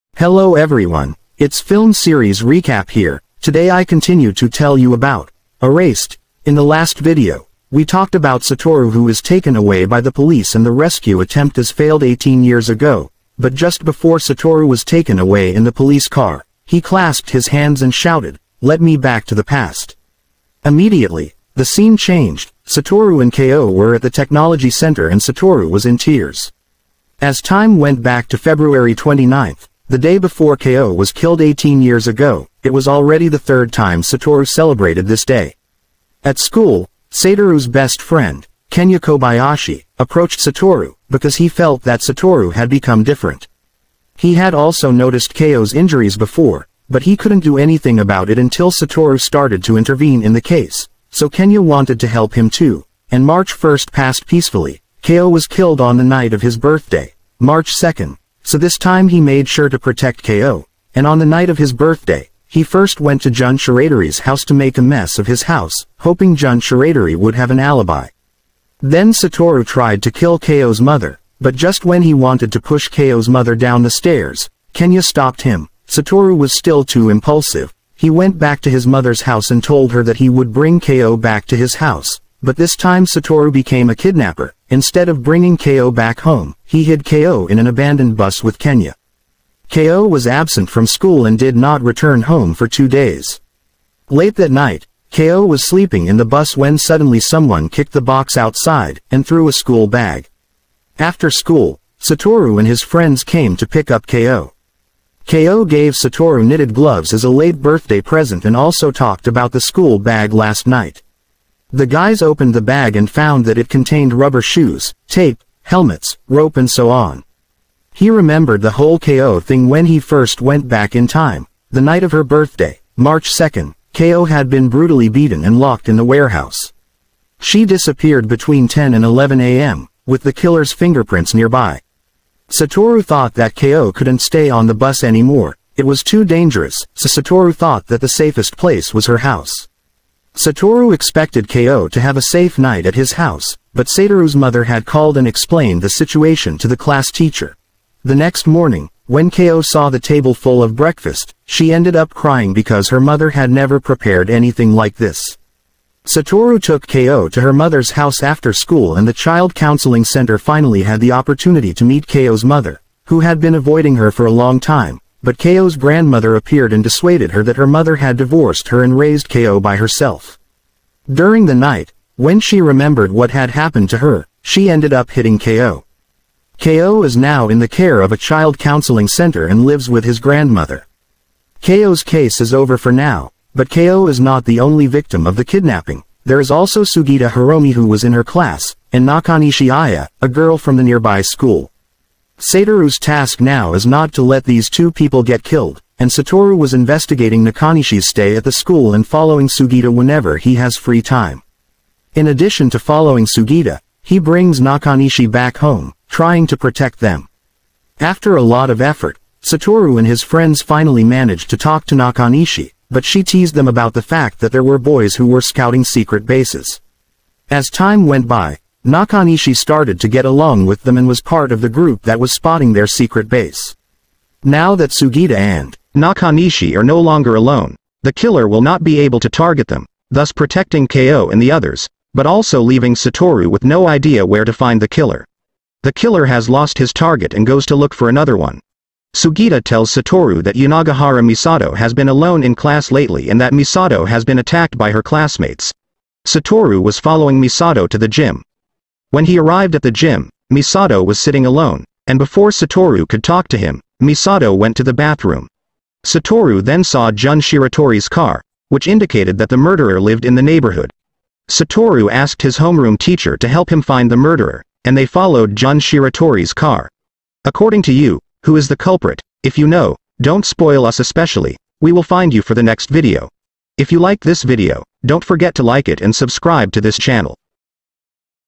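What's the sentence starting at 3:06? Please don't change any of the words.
There is also Sugita Hiromi who was in her class, and Nakanishi Aya, a girl from the nearby school.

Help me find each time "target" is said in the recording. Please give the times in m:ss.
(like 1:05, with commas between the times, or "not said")
3:49, 3:56.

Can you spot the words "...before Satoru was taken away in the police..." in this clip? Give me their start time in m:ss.
0:13.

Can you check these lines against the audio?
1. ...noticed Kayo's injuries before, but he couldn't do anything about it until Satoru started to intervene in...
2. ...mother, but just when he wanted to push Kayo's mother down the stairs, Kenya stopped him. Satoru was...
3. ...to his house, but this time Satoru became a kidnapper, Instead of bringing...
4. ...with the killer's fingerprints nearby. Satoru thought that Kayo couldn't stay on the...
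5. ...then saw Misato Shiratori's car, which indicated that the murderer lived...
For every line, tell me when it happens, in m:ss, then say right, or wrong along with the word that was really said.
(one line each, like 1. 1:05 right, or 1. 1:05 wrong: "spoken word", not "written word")
1. 0:44 right
2. 1:10 right
3. 1:21 right
4. 2:10 right
5. 4:16 wrong: "Jun", not "Misato".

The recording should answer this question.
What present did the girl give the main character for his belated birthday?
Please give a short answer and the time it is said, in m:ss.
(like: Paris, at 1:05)
Knitted gloves, at 1:46.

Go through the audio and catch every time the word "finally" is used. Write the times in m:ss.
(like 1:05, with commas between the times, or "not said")
2:40, 3:30.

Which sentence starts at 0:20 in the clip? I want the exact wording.
Immediately, the scene changed, Satoru and Kayo were at the technology center and Satoru was in tears.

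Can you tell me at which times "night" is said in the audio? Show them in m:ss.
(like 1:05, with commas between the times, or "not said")
0:56, 1:01, 1:34, 1:50, 2:01, 2:22, 2:51.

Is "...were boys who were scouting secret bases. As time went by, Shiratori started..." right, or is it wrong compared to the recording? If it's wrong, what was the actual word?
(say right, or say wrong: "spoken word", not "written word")
wrong: "Nakanishi", not "Shiratori".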